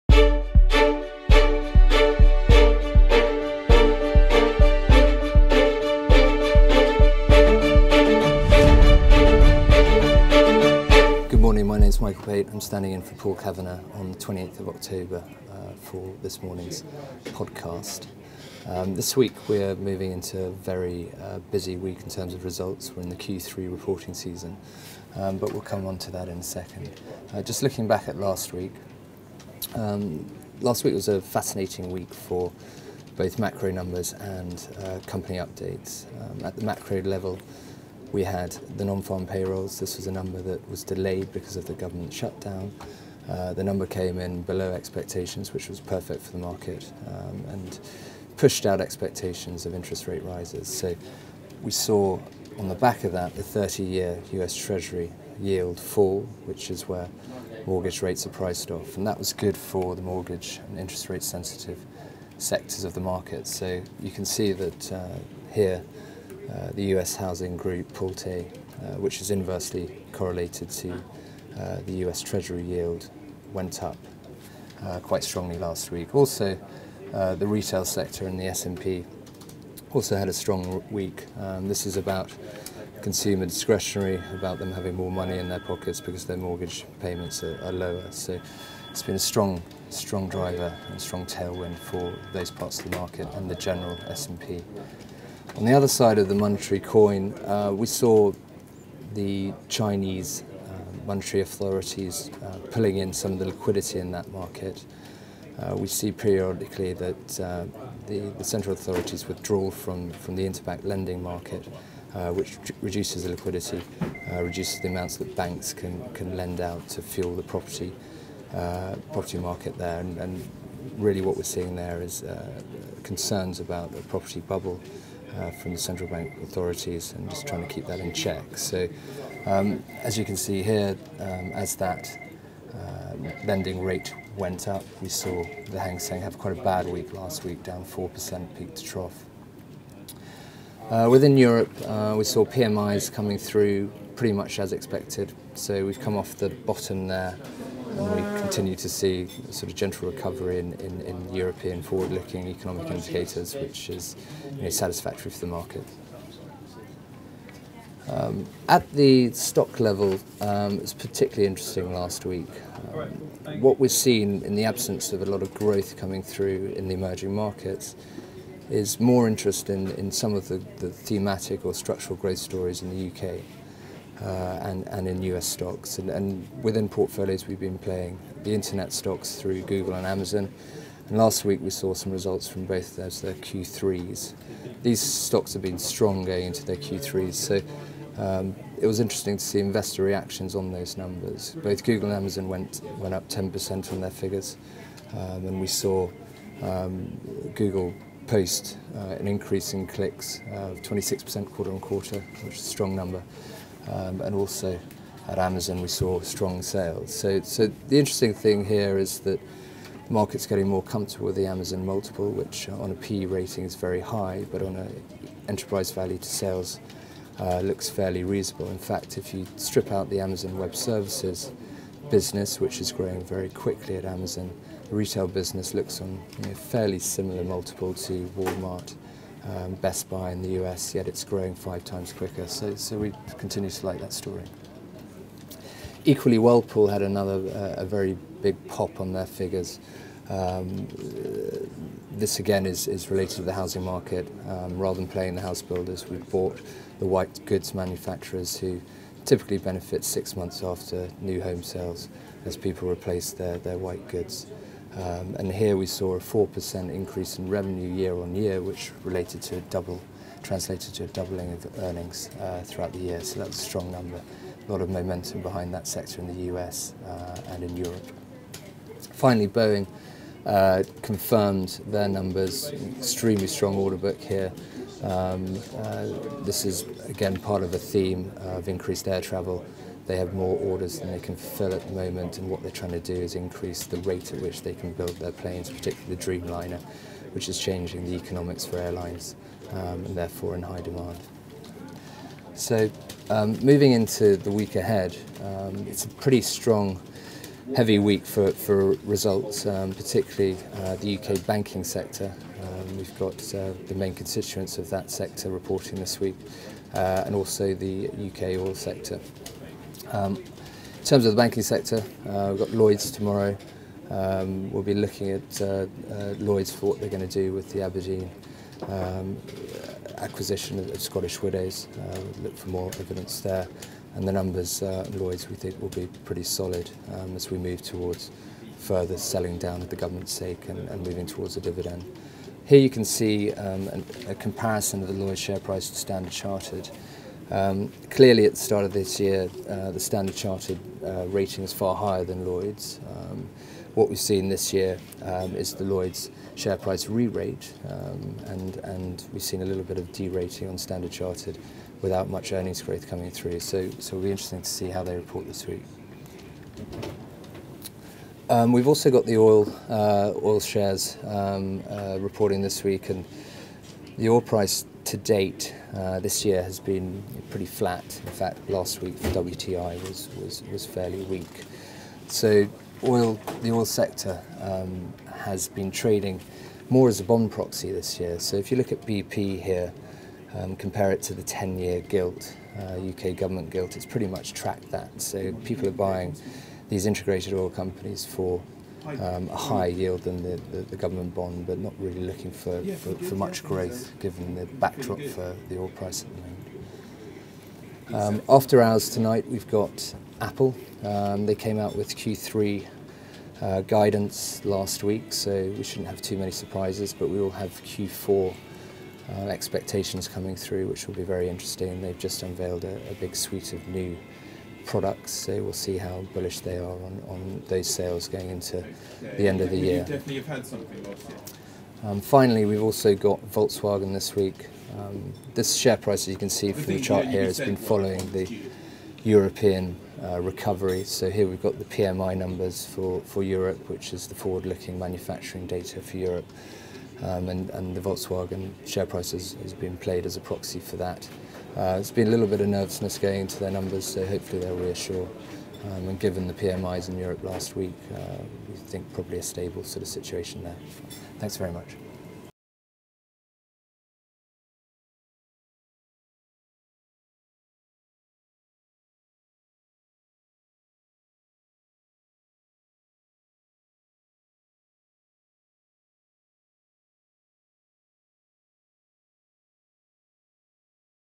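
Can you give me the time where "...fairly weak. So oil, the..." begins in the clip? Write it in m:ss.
6:10.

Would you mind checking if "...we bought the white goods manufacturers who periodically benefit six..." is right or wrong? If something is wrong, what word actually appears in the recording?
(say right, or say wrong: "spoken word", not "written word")
wrong: "typically", not "periodically".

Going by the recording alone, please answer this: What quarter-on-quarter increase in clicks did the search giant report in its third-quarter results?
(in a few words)
26%.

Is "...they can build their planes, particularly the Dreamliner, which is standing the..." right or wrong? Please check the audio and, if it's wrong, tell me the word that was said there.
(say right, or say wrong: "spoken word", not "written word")
wrong: "changing", not "standing".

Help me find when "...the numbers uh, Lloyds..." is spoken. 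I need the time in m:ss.
5:24.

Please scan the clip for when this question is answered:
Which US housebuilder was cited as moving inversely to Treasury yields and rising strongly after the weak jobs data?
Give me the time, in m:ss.
1:07.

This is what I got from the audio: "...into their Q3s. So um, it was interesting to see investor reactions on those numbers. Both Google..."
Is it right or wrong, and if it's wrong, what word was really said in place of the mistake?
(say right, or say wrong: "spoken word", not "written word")
right.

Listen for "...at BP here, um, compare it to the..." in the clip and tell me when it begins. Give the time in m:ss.
6:18.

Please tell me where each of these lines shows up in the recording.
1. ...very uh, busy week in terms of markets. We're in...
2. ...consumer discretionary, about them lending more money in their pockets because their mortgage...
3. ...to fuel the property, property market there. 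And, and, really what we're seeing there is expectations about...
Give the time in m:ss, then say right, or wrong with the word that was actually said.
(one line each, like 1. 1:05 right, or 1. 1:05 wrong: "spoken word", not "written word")
1. 0:20 wrong: "results", not "markets"
2. 1:23 wrong: "having", not "lending"
3. 1:56 wrong: "concerns", not "expectations".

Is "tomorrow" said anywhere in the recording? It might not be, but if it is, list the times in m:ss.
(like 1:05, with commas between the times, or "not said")
5:13.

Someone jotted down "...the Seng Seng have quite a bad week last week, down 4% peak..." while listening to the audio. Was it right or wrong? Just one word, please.
wrong.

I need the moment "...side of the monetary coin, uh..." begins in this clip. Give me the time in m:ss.
1:35.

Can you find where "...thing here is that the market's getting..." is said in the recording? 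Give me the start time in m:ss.
3:28.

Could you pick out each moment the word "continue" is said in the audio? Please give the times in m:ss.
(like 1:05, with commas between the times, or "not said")
2:28, 3:53.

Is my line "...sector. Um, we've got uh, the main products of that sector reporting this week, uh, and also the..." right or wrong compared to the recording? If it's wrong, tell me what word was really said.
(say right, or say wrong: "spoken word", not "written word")
wrong: "constituents", not "products".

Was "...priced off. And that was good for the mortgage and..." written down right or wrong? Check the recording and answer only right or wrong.
right.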